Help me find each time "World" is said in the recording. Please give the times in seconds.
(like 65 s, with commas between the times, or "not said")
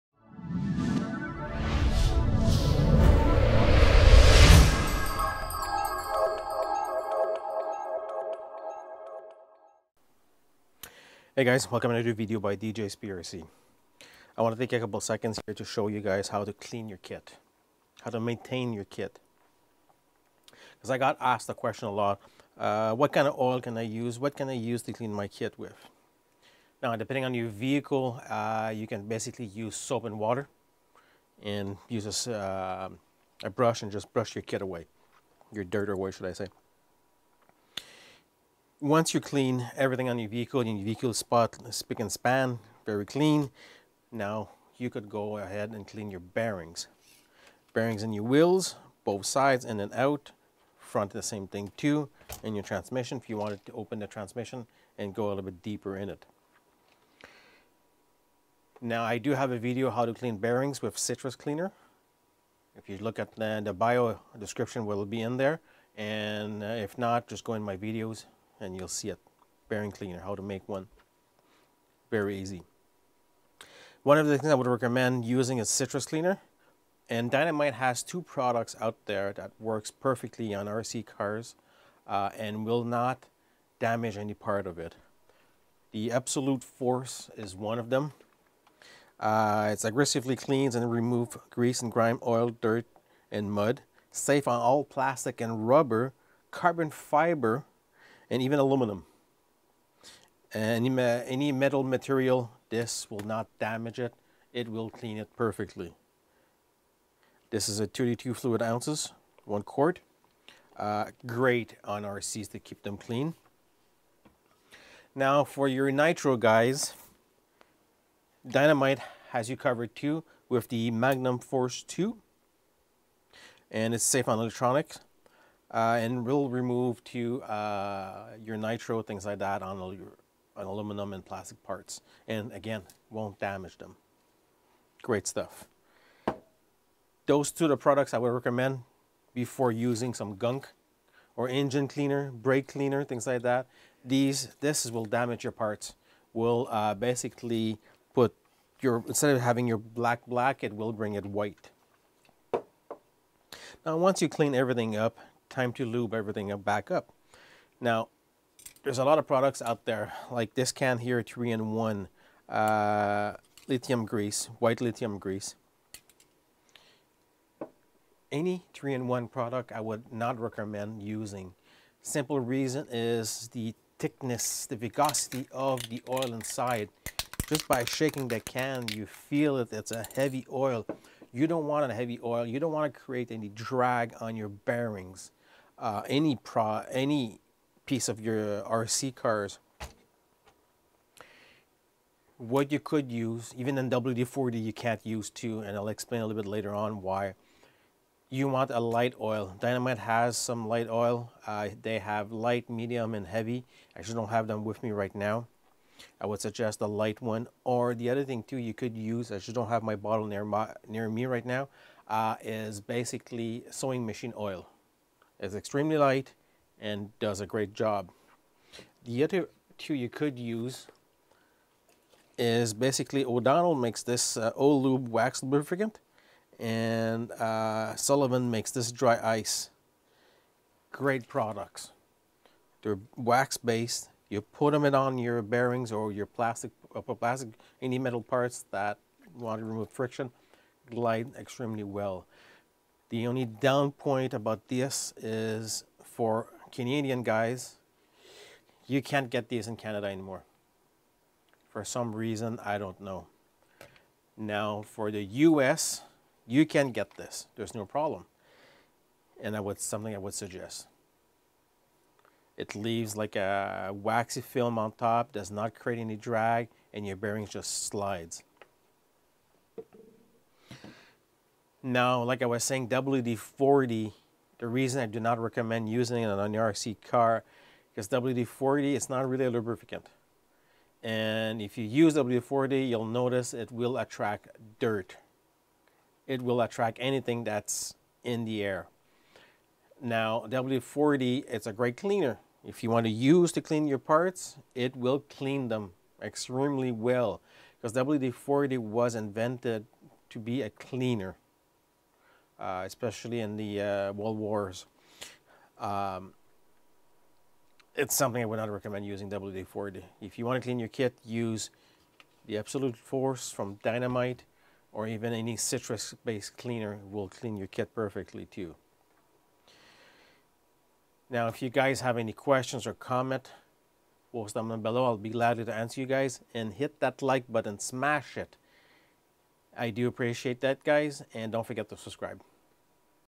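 304 s.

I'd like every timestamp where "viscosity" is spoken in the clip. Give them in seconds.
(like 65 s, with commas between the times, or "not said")
174 s.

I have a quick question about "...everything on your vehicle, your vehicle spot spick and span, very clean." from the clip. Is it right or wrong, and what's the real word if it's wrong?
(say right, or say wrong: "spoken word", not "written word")
right.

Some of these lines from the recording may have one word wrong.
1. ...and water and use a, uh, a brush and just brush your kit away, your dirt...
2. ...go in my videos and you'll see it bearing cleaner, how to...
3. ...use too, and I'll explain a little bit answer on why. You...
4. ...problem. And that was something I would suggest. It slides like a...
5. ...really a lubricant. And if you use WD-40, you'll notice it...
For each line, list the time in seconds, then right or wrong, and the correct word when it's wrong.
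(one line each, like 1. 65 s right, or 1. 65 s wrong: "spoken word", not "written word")
1. 30 s right
2. 67 s right
3. 195 s wrong: "later", not "answer"
4. 257 s wrong: "leaves", not "slides"
5. 279 s right.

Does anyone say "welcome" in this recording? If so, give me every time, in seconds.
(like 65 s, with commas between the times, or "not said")
11 s.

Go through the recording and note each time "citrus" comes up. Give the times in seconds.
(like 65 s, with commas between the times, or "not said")
60 s, 75 s, 315 s.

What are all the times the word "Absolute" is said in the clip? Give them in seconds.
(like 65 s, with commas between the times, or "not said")
86 s, 312 s.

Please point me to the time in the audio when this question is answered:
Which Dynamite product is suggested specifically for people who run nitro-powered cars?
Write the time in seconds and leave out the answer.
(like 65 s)
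120 s.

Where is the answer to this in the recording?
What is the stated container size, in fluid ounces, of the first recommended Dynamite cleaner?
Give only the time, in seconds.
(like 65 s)
107 s.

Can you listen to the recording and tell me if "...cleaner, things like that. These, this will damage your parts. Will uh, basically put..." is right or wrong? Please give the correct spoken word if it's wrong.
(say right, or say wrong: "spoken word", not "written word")
right.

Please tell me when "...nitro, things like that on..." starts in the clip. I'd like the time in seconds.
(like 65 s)
128 s.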